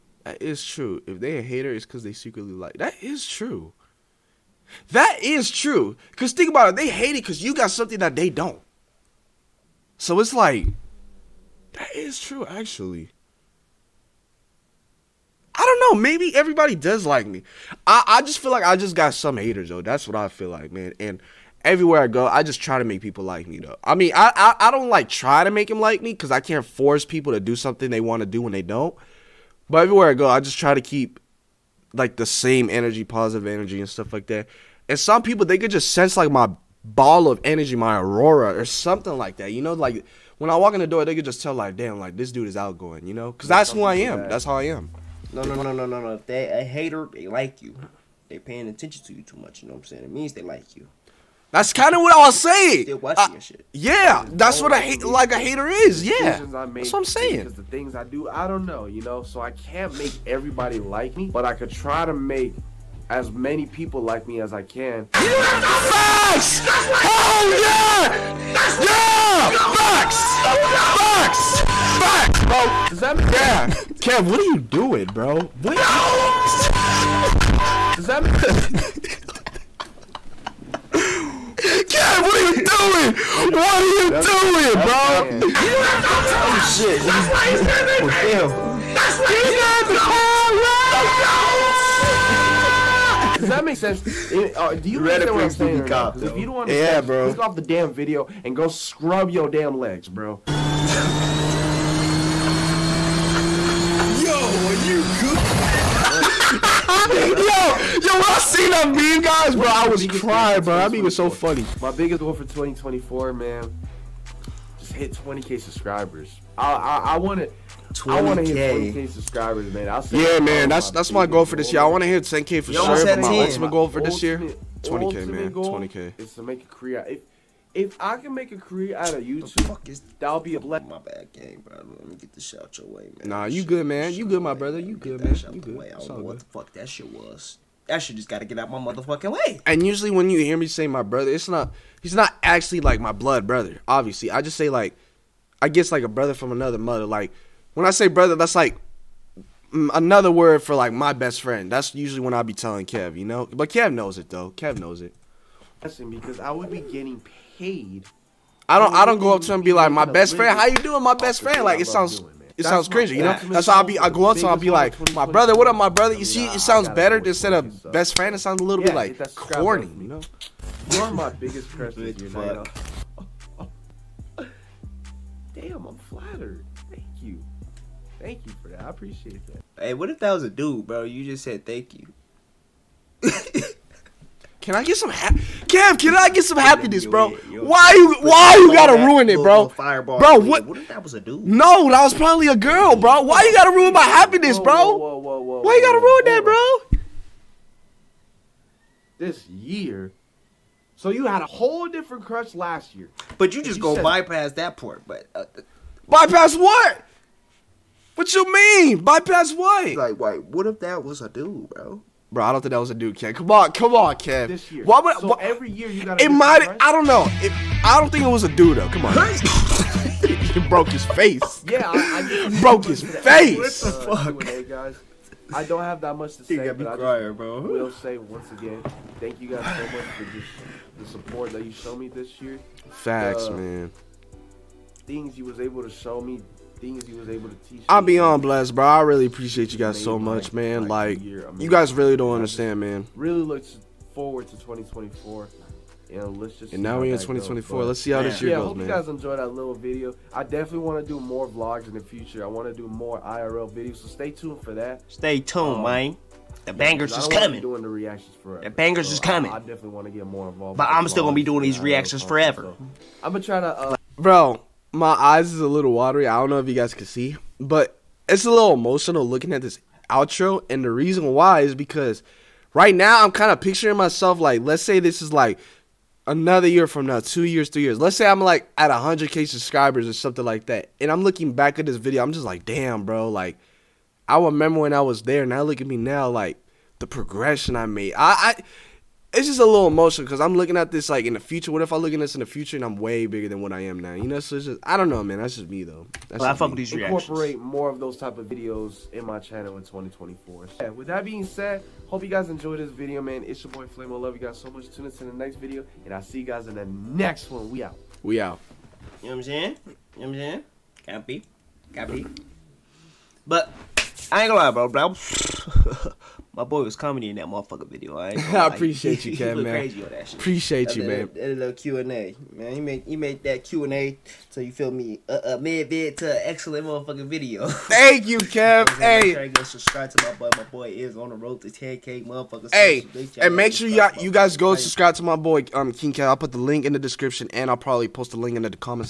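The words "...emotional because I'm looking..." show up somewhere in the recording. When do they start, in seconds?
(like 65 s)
289 s.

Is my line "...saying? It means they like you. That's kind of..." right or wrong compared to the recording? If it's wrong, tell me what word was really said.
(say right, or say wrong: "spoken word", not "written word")
right.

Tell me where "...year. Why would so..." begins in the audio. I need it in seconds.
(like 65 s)
214 s.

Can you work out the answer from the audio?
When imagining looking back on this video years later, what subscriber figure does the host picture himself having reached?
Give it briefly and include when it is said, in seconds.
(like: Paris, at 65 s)
100k, at 278 s.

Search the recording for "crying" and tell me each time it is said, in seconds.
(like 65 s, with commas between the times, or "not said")
110 s, 226 s.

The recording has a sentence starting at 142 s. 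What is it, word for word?
He's not actually like my blood brother.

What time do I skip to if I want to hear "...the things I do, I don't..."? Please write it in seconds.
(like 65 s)
57 s.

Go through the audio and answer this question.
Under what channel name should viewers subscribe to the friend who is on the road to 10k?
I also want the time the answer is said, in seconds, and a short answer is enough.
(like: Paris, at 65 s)
King Kev, at 335 s.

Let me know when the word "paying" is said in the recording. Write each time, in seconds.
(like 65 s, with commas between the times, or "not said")
48 s.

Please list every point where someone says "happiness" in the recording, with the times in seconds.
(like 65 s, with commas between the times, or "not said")
186 s, 194 s.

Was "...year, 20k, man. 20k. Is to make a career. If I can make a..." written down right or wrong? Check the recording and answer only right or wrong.
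right.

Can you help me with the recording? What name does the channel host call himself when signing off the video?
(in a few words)
Flamo.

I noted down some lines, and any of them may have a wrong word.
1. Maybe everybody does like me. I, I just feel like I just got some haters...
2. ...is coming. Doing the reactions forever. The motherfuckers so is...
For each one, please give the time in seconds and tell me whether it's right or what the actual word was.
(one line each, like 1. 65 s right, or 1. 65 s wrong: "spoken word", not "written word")
1. 16 s right
2. 257 s wrong: "bangers", not "motherfuckers".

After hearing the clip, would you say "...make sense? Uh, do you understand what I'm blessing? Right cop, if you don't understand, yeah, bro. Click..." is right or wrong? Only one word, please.
wrong.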